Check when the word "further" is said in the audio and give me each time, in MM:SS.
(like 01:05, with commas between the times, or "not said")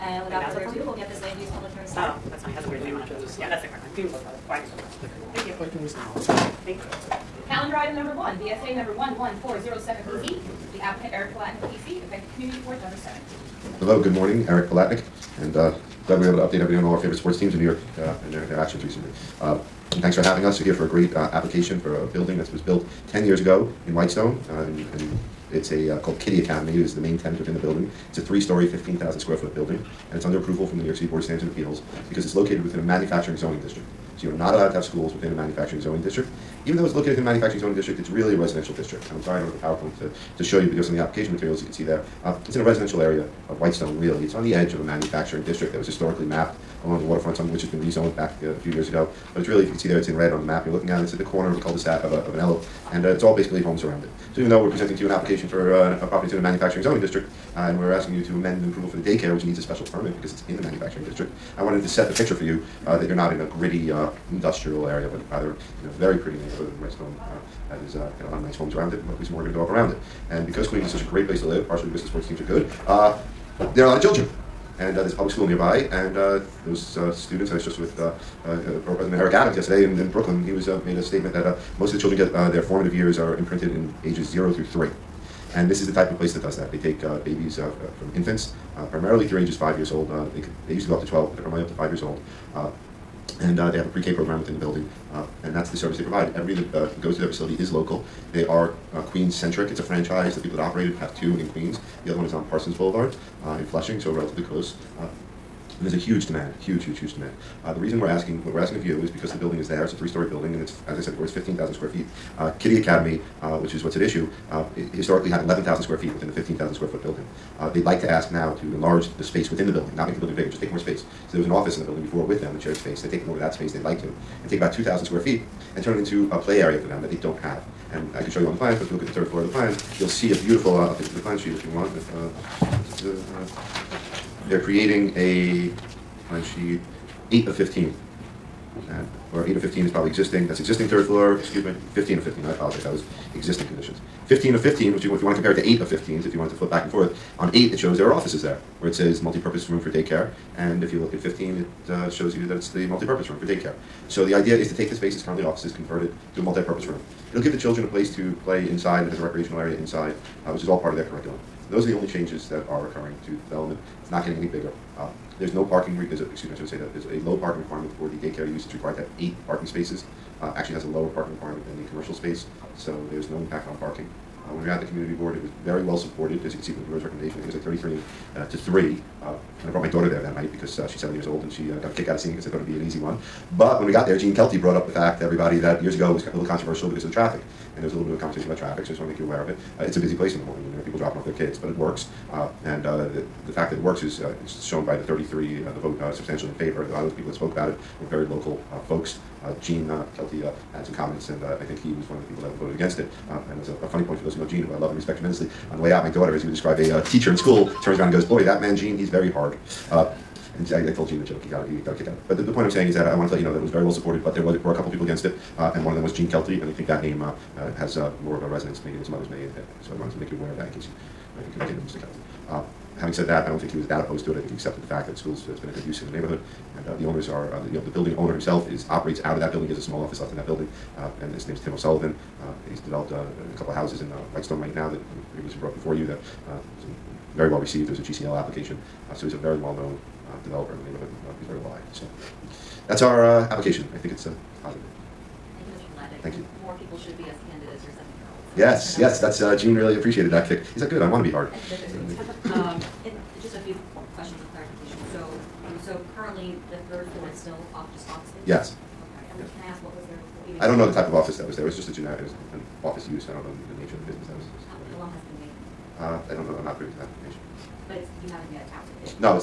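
00:00.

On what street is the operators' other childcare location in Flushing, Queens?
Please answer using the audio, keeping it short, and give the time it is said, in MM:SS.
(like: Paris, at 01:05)
Parsons Boulevard, at 01:42.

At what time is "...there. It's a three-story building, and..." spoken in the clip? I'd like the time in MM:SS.
01:49.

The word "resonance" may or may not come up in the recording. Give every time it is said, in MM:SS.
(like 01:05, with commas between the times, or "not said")
03:38.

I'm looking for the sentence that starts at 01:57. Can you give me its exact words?
Uh, they'd like to ask now to enlarge the space within the building, not make the building bigger, just take more space.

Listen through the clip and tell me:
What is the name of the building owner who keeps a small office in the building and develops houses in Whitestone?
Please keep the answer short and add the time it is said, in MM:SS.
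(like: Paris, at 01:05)
Tim O'Sullivan, at 03:51.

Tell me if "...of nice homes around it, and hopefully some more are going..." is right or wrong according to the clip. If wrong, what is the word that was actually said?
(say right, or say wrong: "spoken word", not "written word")
right.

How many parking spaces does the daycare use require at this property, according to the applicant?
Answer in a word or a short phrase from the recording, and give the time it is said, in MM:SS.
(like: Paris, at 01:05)
8, at 02:49.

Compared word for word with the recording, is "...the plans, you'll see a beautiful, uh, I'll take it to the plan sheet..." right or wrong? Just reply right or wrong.
right.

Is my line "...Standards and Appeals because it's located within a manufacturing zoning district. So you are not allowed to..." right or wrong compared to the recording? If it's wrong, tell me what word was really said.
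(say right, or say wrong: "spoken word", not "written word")
right.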